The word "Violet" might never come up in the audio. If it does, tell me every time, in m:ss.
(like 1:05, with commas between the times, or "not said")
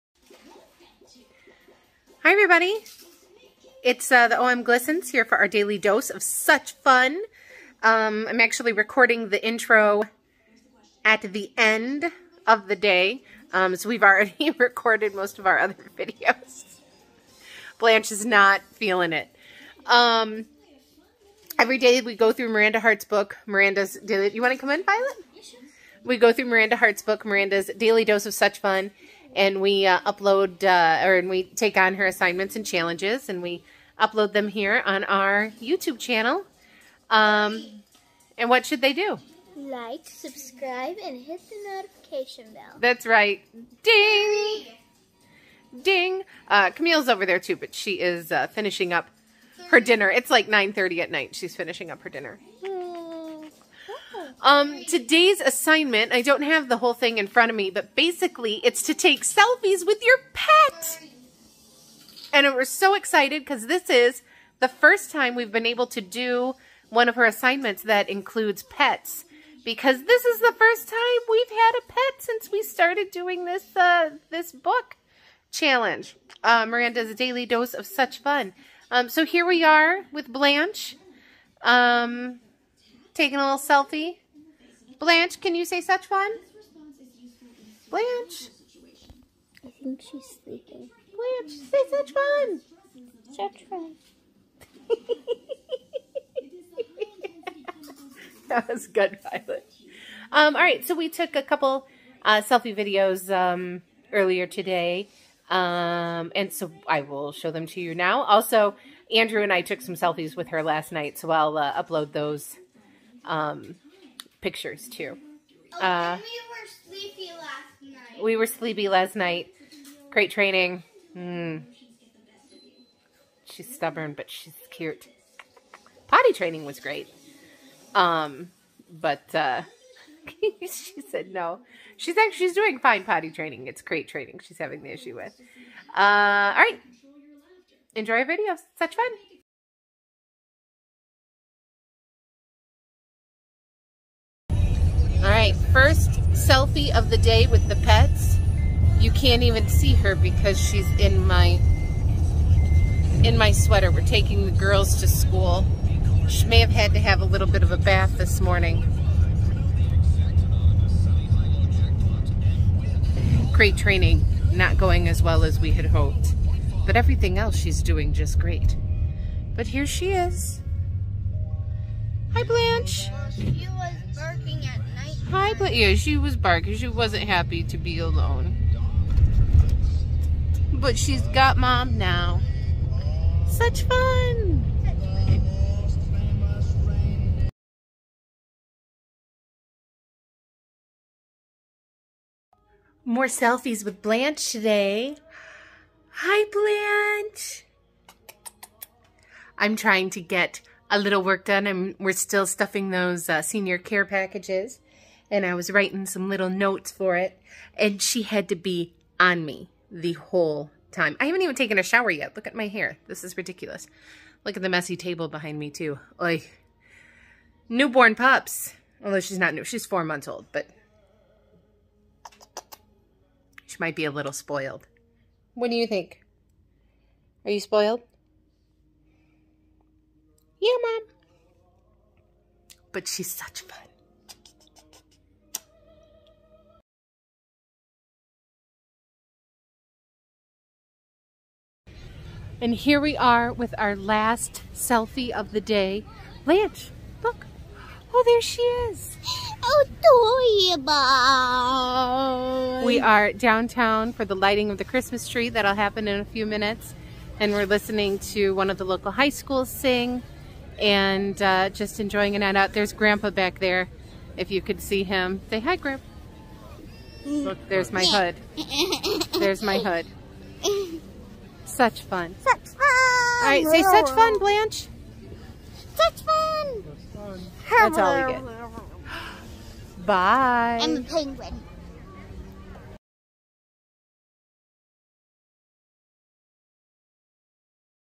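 0:24, 1:39.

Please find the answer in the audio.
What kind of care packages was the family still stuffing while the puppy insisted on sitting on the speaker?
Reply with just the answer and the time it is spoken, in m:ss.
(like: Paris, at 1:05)
Senior care packages, at 3:23.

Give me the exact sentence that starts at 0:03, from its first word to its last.
It's uh, the OMGlissons here for our daily dose of such fun.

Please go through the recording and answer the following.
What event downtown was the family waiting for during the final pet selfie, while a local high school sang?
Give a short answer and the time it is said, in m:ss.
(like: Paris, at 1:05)
Lighting of the Christmas tree, at 4:14.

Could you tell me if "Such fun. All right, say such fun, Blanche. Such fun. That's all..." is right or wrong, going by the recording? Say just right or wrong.
right.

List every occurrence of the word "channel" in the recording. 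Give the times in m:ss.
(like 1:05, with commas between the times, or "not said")
0:35.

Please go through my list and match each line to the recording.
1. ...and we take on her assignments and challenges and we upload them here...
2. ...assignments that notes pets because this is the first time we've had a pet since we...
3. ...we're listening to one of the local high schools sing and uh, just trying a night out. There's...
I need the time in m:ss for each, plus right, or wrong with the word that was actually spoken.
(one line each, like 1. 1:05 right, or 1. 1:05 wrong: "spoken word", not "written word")
1. 0:31 right
2. 1:07 wrong: "includes", not "notes"
3. 4:17 wrong: "enjoying", not "trying".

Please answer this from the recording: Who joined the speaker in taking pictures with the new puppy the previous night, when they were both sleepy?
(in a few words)
Andrew.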